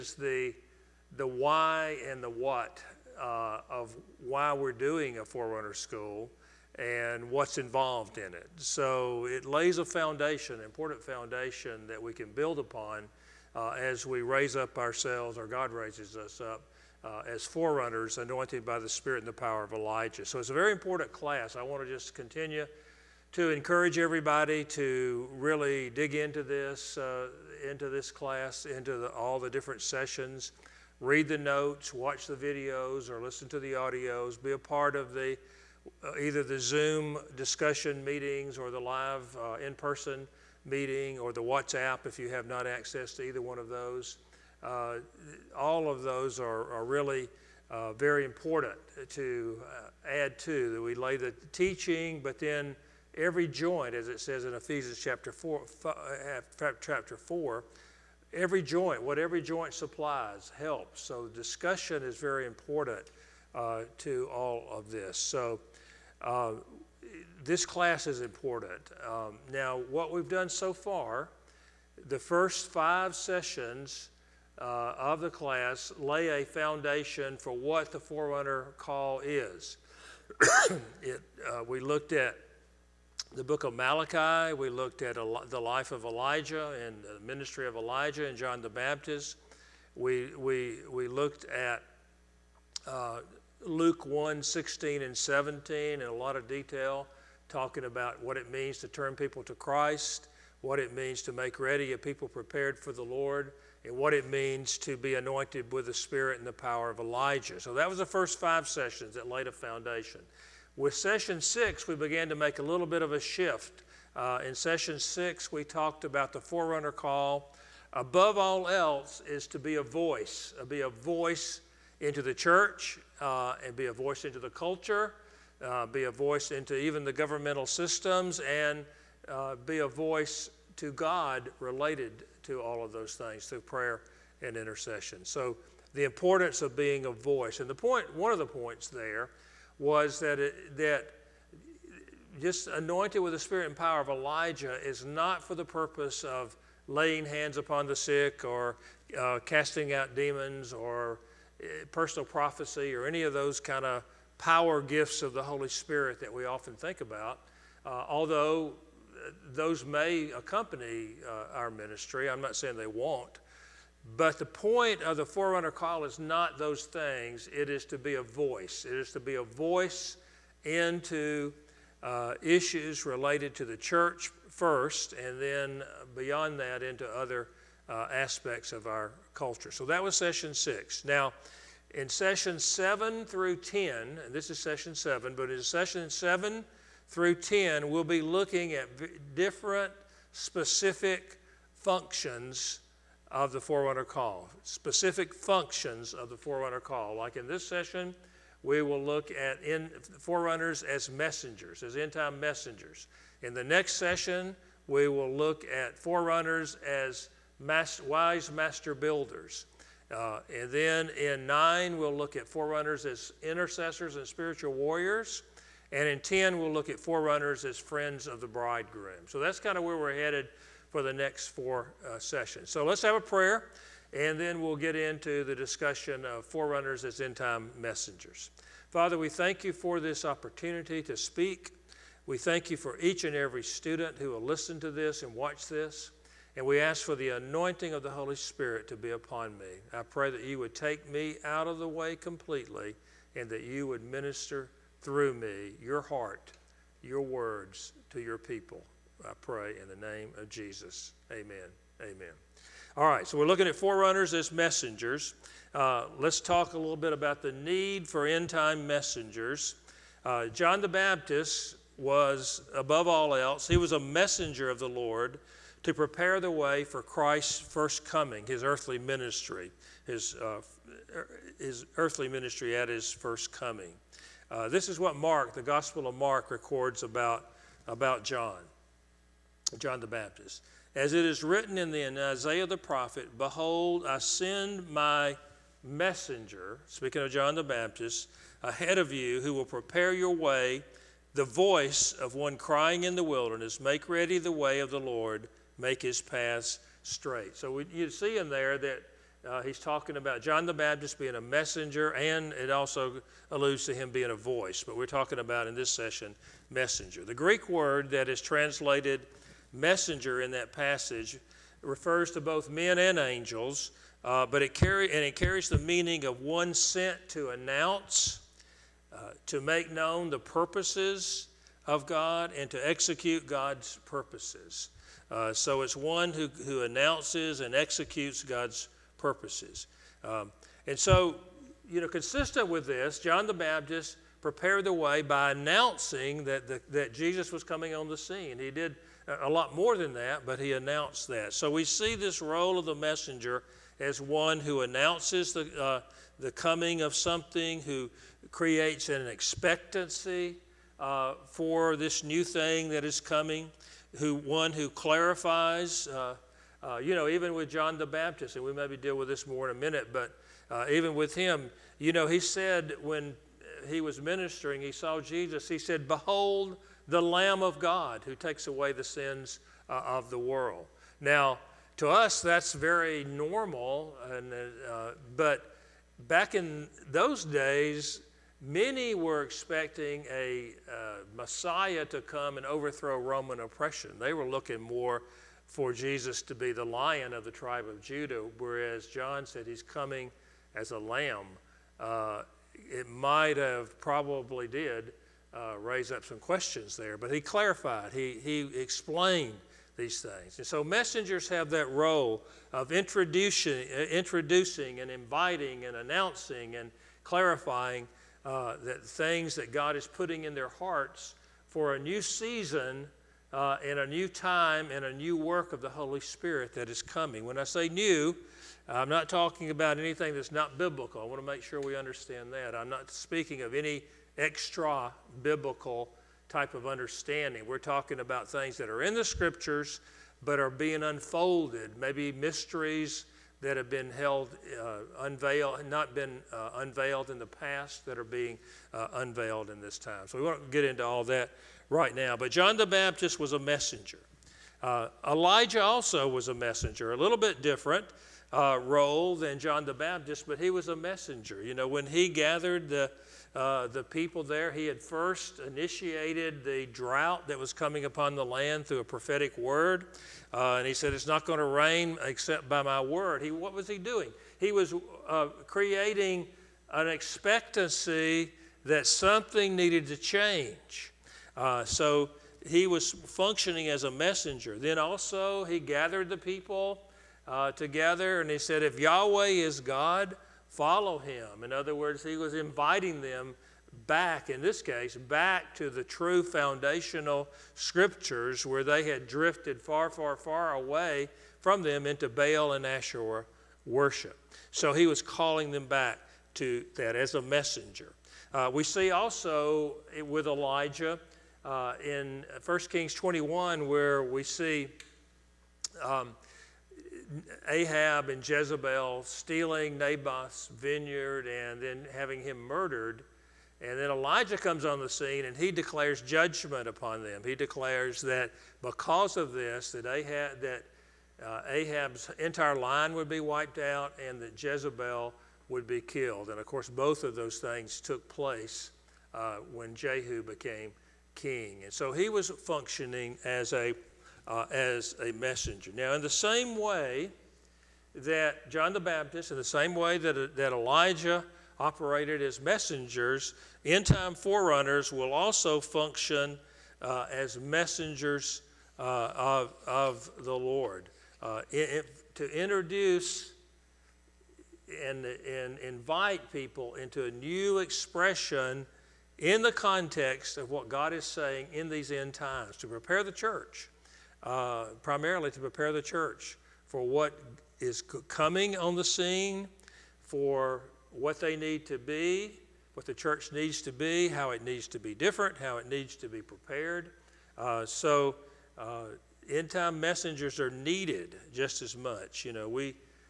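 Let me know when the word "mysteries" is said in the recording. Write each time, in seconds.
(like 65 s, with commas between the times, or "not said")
432 s.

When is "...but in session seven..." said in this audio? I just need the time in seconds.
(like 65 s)
185 s.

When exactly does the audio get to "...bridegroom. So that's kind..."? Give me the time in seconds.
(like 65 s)
218 s.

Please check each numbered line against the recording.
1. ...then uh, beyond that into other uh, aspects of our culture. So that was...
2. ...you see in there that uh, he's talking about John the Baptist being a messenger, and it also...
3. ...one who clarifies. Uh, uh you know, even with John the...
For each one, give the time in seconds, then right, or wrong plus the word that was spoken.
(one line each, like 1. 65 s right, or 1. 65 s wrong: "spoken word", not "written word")
1. 175 s right
2. 297 s right
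3. 354 s right.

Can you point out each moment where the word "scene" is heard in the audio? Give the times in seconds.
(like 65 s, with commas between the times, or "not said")
338 s, 515 s, 569 s.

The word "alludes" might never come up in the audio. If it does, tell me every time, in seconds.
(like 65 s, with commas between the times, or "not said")
303 s.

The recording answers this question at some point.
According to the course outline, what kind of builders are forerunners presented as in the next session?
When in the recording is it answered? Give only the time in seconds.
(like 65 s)
208 s.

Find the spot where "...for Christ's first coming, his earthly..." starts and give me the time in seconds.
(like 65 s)
266 s.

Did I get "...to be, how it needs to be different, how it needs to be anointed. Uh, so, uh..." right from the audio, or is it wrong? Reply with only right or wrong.
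wrong.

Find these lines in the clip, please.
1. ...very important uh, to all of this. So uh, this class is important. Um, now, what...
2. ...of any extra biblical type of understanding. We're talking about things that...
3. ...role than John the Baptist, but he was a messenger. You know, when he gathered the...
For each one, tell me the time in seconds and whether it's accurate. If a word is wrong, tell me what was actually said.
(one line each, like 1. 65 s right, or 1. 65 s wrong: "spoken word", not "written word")
1. 62 s right
2. 423 s right
3. 448 s right.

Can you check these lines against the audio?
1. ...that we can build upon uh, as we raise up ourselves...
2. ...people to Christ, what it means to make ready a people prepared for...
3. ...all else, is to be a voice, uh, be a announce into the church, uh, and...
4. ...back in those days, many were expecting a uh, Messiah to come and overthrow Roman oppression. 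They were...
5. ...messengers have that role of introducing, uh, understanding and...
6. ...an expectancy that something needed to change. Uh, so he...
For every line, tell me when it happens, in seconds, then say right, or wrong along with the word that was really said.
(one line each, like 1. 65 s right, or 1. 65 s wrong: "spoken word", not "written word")
1. 11 s right
2. 99 s right
3. 118 s wrong: "voice", not "announce"
4. 376 s right
5. 400 s wrong: "introducing", not "understanding"
6. 466 s right.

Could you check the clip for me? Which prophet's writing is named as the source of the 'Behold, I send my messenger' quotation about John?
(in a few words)
Isaiah.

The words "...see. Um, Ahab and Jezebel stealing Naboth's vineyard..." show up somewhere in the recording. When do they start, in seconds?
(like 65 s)
504 s.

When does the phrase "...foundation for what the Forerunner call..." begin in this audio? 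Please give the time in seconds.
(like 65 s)
76 s.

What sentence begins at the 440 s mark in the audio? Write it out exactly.
So we won't get into all that right now.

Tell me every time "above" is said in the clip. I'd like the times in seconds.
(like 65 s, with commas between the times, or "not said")
117 s, 262 s.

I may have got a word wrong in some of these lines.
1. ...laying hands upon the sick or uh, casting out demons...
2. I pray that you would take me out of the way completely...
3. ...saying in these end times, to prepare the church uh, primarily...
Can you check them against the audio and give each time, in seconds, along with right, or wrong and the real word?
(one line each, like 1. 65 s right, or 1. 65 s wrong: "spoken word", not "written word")
1. 146 s right
2. 239 s right
3. 561 s right.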